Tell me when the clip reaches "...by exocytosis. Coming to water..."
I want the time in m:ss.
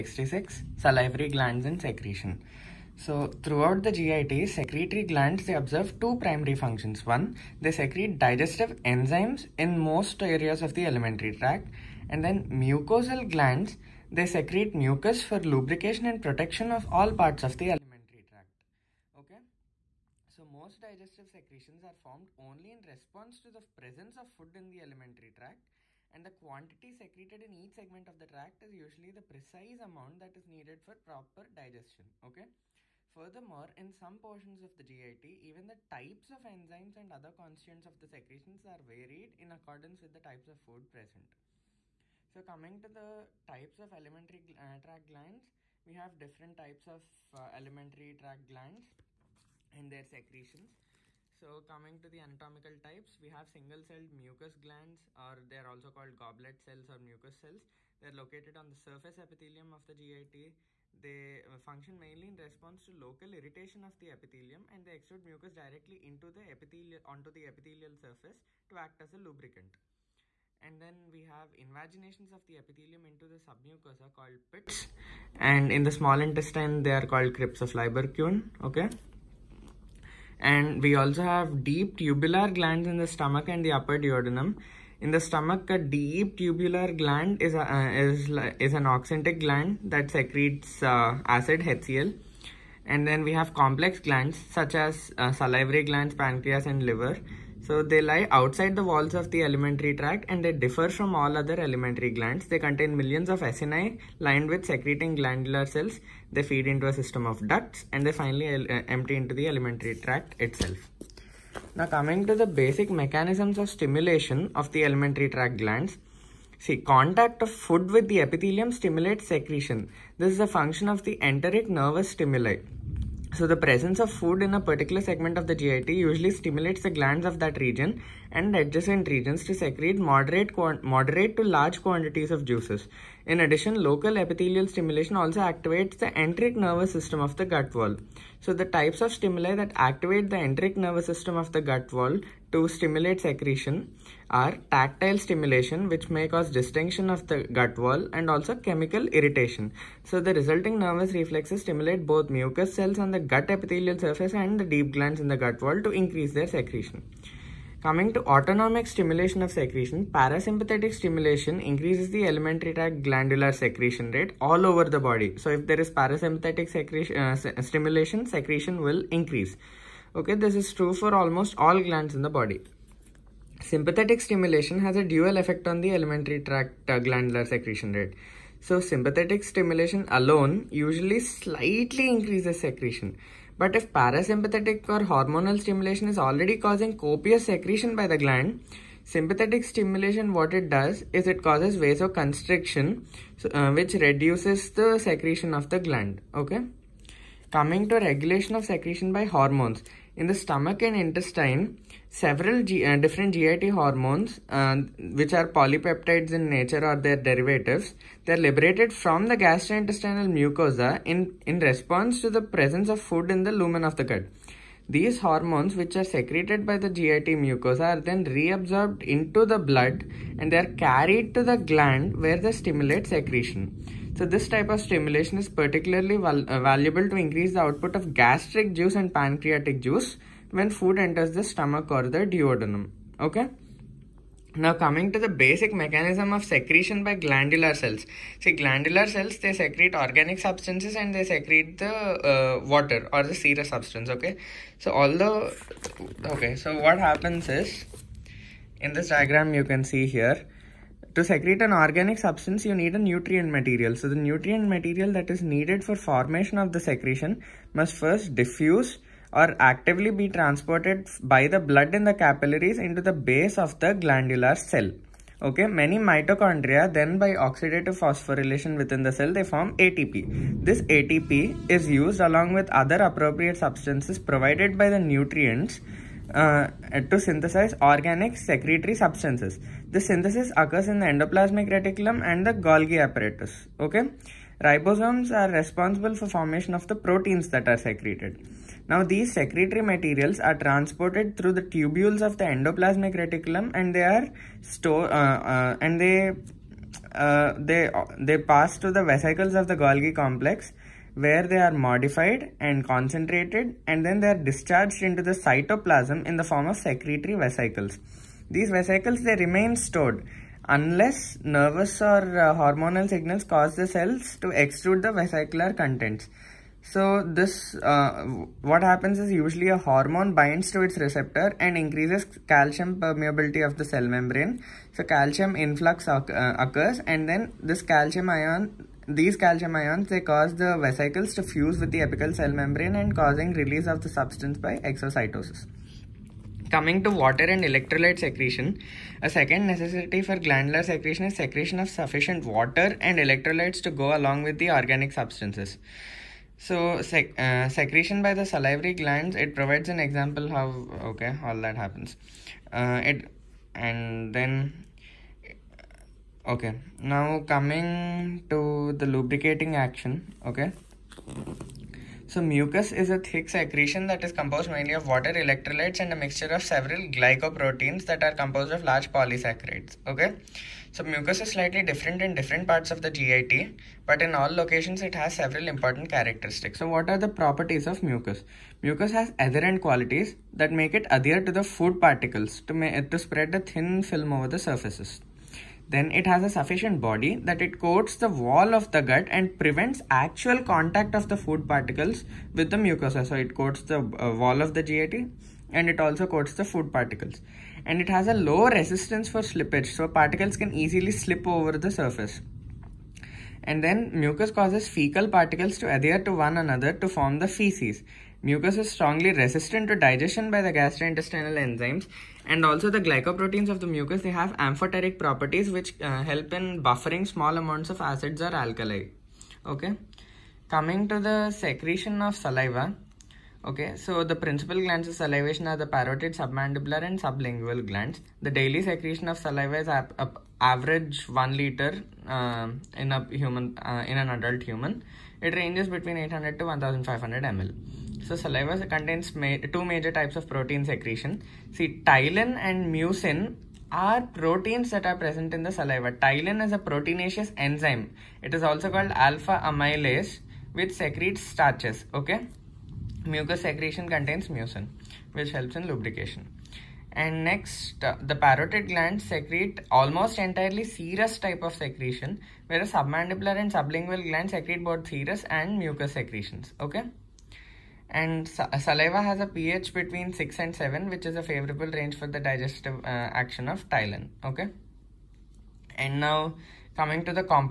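5:34.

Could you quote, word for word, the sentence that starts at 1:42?
They contain millions of acini lined with secreting glandular cells.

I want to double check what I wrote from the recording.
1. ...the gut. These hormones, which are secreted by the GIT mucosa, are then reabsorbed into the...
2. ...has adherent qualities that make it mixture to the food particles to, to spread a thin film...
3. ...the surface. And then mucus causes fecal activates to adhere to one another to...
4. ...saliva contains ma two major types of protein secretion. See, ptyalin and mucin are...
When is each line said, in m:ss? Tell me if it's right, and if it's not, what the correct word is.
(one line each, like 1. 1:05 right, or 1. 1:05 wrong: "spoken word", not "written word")
1. 3:33 right
2. 6:19 wrong: "adhere", not "mixture"
3. 6:41 wrong: "particles", not "activates"
4. 7:18 right.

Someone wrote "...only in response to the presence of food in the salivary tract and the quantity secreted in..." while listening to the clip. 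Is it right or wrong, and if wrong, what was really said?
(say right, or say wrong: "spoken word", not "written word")
wrong: "alimentary", not "salivary".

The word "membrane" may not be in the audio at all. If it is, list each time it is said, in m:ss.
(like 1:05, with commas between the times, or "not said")
5:24, 5:32.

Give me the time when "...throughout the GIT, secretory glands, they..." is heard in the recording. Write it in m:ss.
0:03.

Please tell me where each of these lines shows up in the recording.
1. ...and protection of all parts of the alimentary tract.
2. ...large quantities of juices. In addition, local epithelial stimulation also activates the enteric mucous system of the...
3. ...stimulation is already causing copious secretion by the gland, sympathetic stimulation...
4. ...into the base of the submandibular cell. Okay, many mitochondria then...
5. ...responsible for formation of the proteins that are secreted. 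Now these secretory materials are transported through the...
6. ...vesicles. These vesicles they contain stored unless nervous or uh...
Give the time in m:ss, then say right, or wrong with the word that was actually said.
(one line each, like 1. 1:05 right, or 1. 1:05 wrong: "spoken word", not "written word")
1. 0:16 right
2. 2:11 wrong: "nervous", not "mucous"
3. 3:05 right
4. 4:22 wrong: "glandular", not "submandibular"
5. 4:45 right
6. 5:07 wrong: "remain", not "contain".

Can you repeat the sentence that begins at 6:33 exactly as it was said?
So it coats the uh, wall of the GAT and it also coats the food particles.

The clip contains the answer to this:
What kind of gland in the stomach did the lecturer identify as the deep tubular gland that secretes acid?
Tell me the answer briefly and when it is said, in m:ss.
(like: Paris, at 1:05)
Oxyntic gland, at 1:28.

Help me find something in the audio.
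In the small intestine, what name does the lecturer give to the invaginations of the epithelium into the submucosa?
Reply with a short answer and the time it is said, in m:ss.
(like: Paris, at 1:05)
Crypts of Lieberkuhn, at 1:17.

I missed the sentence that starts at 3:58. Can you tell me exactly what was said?
See glandular cells they secrete organic substances and they secrete the uh, water or the serous substance okay.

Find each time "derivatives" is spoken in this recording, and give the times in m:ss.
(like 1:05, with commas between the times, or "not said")
3:27.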